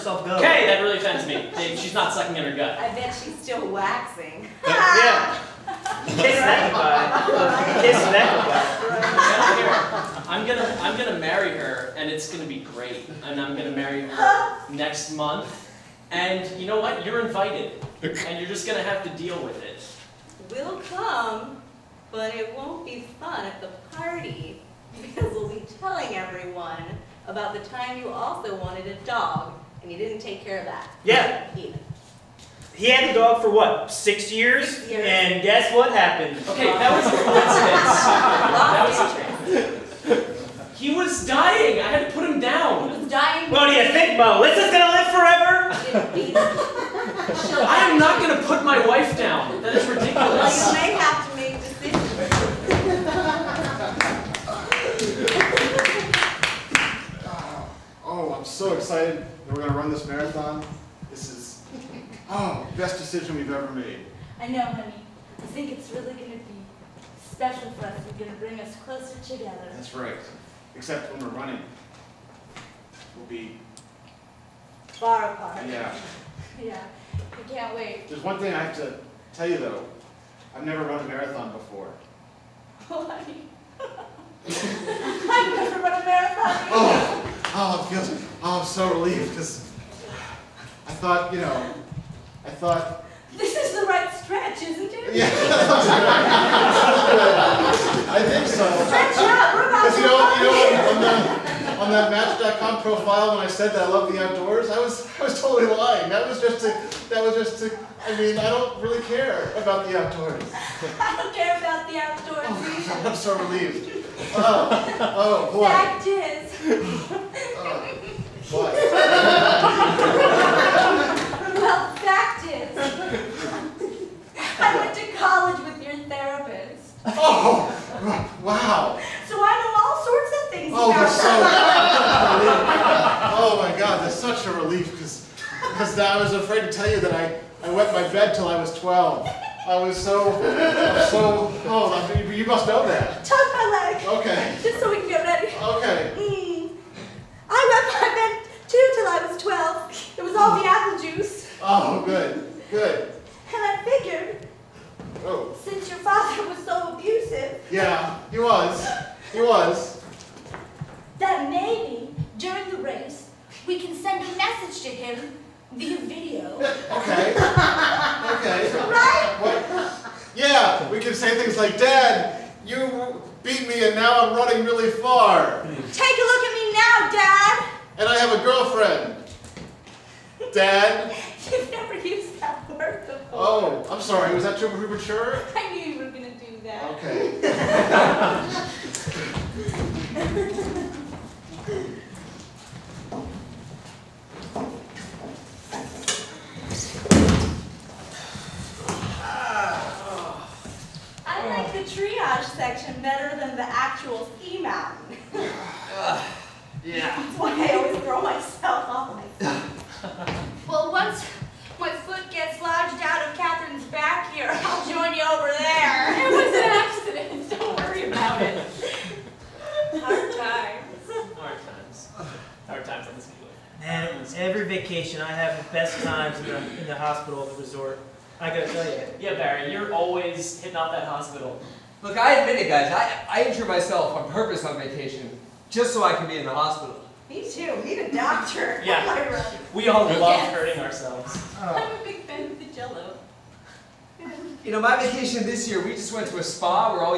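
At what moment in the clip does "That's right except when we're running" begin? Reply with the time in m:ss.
1:09.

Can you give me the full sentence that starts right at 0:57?
oh, oh, I'm so excited that we're gonna run this marathon.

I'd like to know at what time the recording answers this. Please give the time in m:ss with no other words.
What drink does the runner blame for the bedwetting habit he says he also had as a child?
2:30.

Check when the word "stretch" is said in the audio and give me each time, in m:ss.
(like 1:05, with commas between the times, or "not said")
1:34, 1:38.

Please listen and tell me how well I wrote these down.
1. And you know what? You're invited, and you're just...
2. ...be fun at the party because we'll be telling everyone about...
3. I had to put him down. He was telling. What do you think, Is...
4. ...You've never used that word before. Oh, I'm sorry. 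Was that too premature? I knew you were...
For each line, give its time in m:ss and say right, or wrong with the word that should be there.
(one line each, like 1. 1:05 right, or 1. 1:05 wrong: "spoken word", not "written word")
1. 0:16 right
2. 0:22 right
3. 0:41 wrong: "dying", not "telling"
4. 3:01 right.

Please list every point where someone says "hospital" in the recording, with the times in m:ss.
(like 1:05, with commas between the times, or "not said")
3:46, 3:51, 3:56.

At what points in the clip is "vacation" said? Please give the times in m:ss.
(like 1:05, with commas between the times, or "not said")
3:44, 3:54, 4:04.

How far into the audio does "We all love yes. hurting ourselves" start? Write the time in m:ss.
3:59.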